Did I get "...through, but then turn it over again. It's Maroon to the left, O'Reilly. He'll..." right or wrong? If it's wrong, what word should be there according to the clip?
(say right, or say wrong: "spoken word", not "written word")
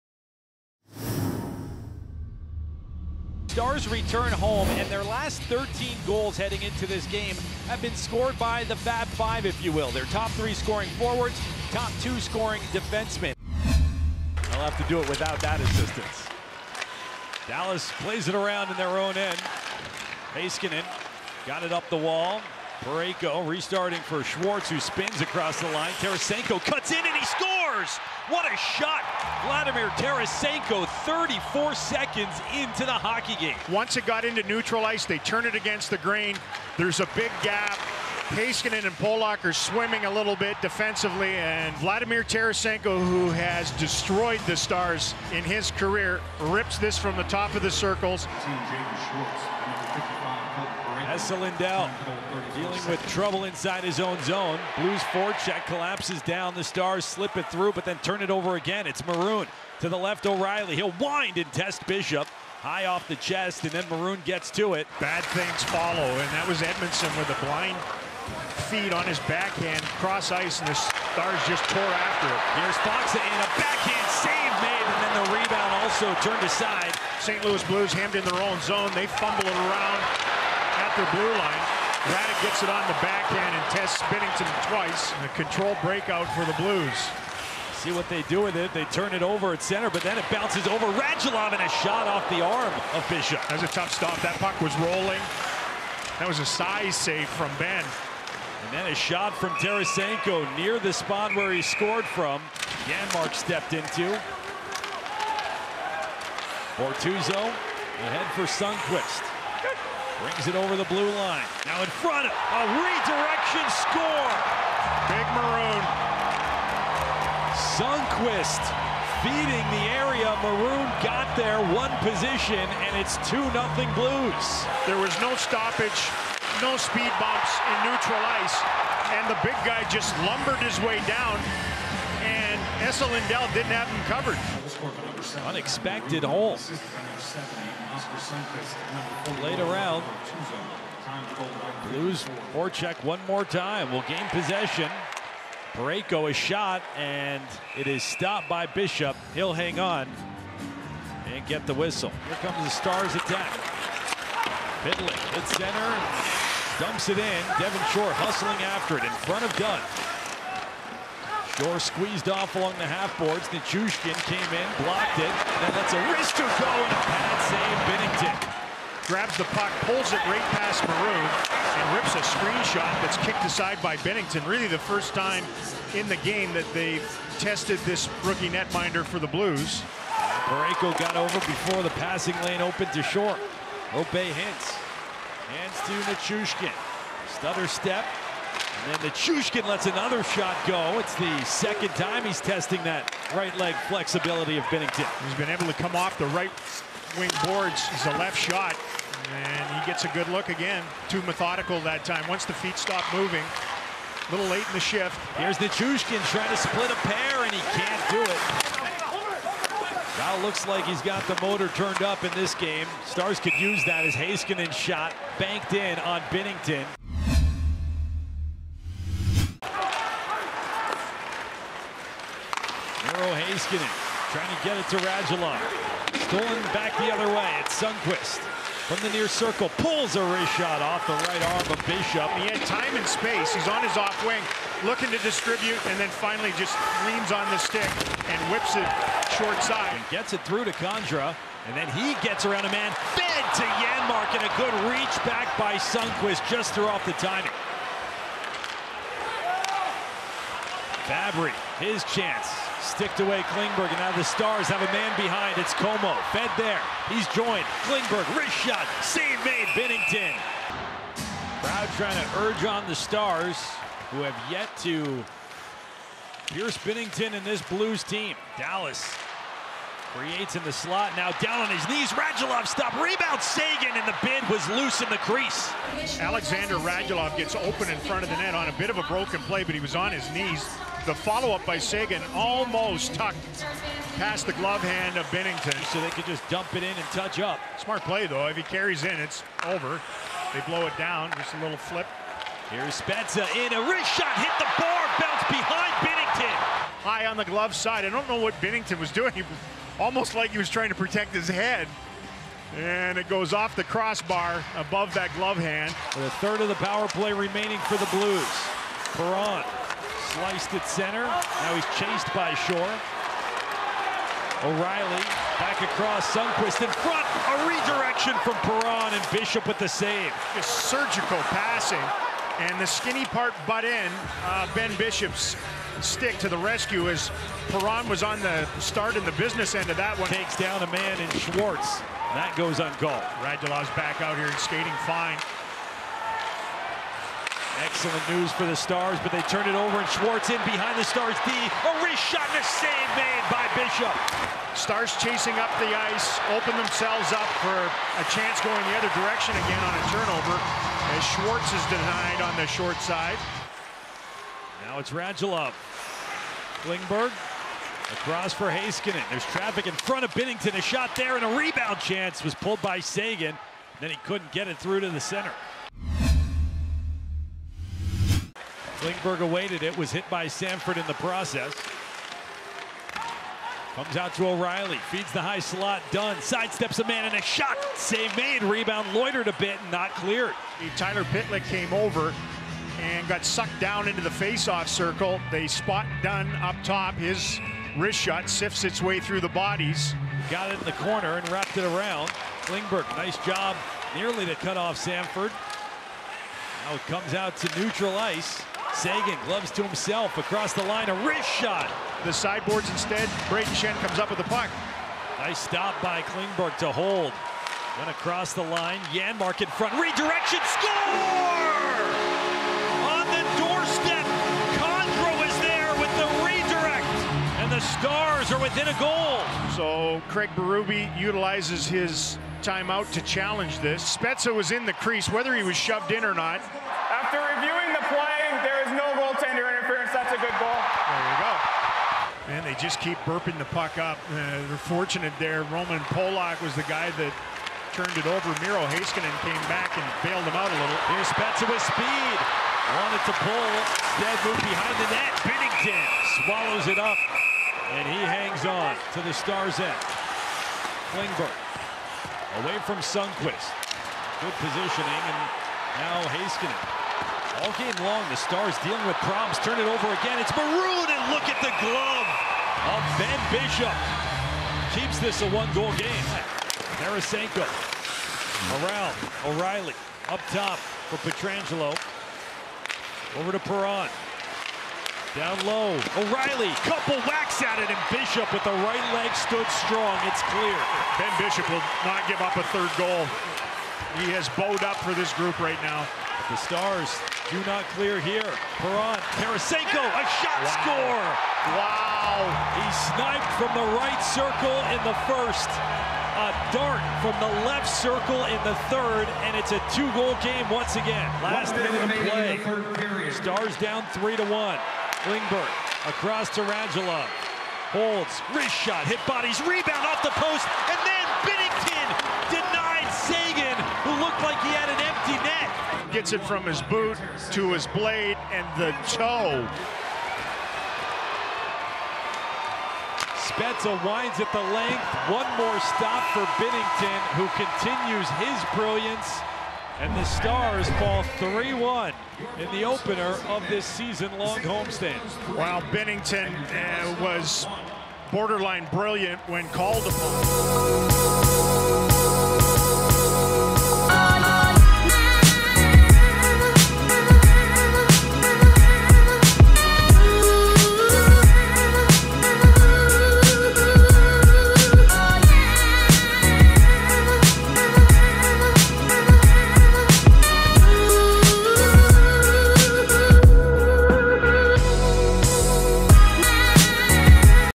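right.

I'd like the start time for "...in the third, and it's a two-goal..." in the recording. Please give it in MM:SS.
08:18.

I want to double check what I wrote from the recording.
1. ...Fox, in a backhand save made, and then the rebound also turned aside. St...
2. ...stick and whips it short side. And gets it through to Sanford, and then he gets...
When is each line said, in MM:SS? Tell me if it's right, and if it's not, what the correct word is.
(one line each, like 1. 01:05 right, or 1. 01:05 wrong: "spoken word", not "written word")
1. 01:12 right
2. 03:57 wrong: "Condra", not "Sanford".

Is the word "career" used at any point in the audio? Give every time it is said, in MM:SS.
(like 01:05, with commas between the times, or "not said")
00:45.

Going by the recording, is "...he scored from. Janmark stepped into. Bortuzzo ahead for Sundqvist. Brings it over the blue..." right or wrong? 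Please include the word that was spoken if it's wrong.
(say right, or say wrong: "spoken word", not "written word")
right.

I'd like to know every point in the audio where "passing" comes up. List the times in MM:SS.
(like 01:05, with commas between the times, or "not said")
03:02, 05:21.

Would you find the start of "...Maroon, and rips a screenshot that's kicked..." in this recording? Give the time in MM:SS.
02:50.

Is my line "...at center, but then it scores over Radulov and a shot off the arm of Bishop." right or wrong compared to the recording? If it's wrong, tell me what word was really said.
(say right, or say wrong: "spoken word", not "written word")
wrong: "bounces", not "scores".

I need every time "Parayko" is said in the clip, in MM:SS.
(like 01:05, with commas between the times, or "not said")
00:22, 02:25, 03:00.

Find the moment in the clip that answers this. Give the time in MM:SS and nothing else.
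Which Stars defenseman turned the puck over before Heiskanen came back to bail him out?
07:15.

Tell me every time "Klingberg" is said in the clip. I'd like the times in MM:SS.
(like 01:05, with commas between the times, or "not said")
04:13, 04:17, 05:56, 06:09, 06:32, 06:46, 07:31, 08:25.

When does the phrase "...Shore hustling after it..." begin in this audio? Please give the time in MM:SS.
02:37.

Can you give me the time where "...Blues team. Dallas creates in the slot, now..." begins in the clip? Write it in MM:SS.
04:27.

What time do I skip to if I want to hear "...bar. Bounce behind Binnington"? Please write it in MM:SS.
04:54.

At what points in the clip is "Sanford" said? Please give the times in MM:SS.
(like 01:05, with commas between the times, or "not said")
06:10, 06:34.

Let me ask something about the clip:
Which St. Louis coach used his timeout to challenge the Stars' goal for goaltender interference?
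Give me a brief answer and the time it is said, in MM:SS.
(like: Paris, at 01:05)
Craig Berube, at 07:00.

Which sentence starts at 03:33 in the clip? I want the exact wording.
Stars could use that as Heiskanen shot banked in on Binnington.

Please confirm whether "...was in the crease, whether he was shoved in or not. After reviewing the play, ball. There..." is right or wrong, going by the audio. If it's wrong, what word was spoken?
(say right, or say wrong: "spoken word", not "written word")
right.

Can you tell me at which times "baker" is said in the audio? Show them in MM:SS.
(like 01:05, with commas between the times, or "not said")
not said.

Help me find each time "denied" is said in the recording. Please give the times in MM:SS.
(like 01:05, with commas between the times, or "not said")
05:51, 08:32.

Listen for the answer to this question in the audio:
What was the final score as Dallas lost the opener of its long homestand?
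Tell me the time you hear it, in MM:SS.
08:51.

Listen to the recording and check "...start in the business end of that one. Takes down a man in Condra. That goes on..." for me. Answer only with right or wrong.
wrong.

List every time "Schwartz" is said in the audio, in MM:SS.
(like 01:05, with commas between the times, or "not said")
00:24, 05:31, 05:40, 05:51.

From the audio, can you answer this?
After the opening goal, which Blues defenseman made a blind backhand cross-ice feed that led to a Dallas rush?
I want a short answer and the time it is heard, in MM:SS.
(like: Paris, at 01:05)
Edmundson, at 01:06.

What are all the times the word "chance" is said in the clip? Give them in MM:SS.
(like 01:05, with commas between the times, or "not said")
04:12, 05:48, 06:01.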